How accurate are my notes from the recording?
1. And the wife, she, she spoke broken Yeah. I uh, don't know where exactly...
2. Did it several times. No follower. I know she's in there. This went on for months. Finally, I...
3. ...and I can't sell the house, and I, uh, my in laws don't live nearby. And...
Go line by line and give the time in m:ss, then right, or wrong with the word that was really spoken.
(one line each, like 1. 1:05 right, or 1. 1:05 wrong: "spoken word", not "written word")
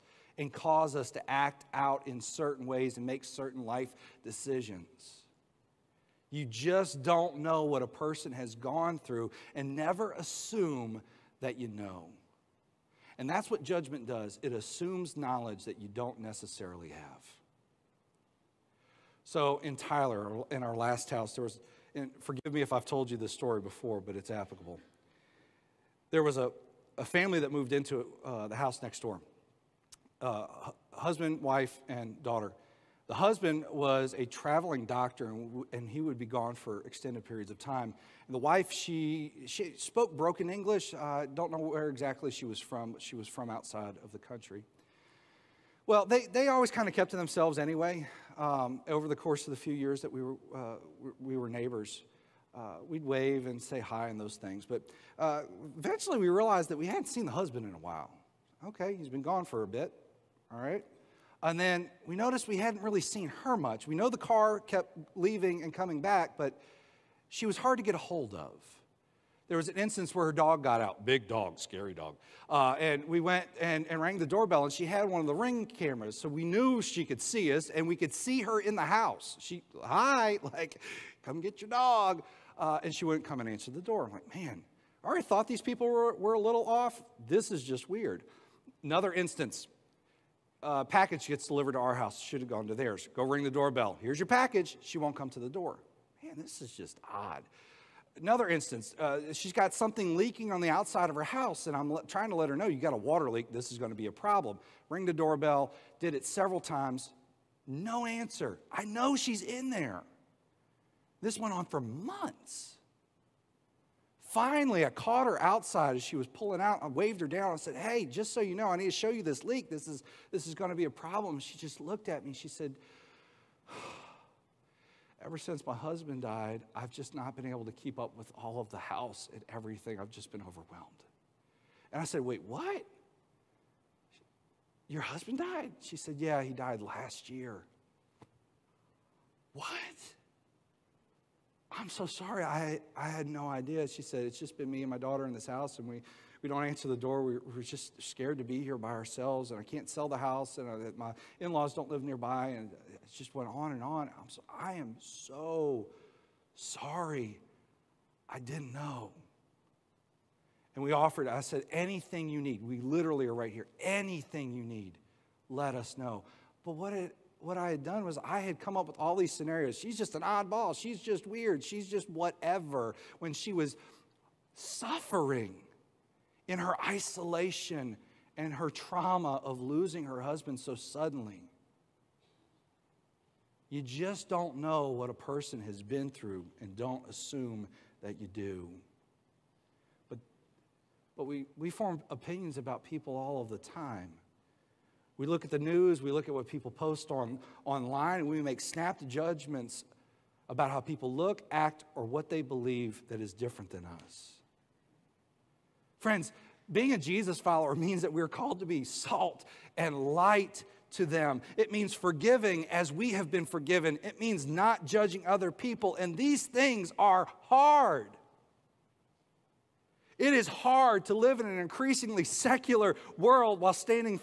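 1. 0:38 wrong: "English", not "Yeah"
2. 1:45 wrong: "answer", not "follower"
3. 2:29 right.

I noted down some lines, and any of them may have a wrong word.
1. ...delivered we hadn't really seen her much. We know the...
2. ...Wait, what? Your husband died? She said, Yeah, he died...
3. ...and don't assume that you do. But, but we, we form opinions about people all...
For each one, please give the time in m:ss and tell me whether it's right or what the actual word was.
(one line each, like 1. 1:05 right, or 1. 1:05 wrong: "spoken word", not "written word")
1. 1:02 wrong: "noticed", not "delivered"
2. 2:12 right
3. 3:06 right.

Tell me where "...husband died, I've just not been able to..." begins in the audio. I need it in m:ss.
2:05.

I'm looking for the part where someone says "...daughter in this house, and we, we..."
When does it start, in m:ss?
2:24.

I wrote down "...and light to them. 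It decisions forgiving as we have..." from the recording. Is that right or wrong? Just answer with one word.
wrong.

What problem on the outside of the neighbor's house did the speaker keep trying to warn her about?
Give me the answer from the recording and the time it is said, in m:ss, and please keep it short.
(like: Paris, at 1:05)
A water leak, at 1:42.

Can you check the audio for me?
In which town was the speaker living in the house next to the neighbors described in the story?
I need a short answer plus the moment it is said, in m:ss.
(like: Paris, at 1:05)
Tyler, at 0:19.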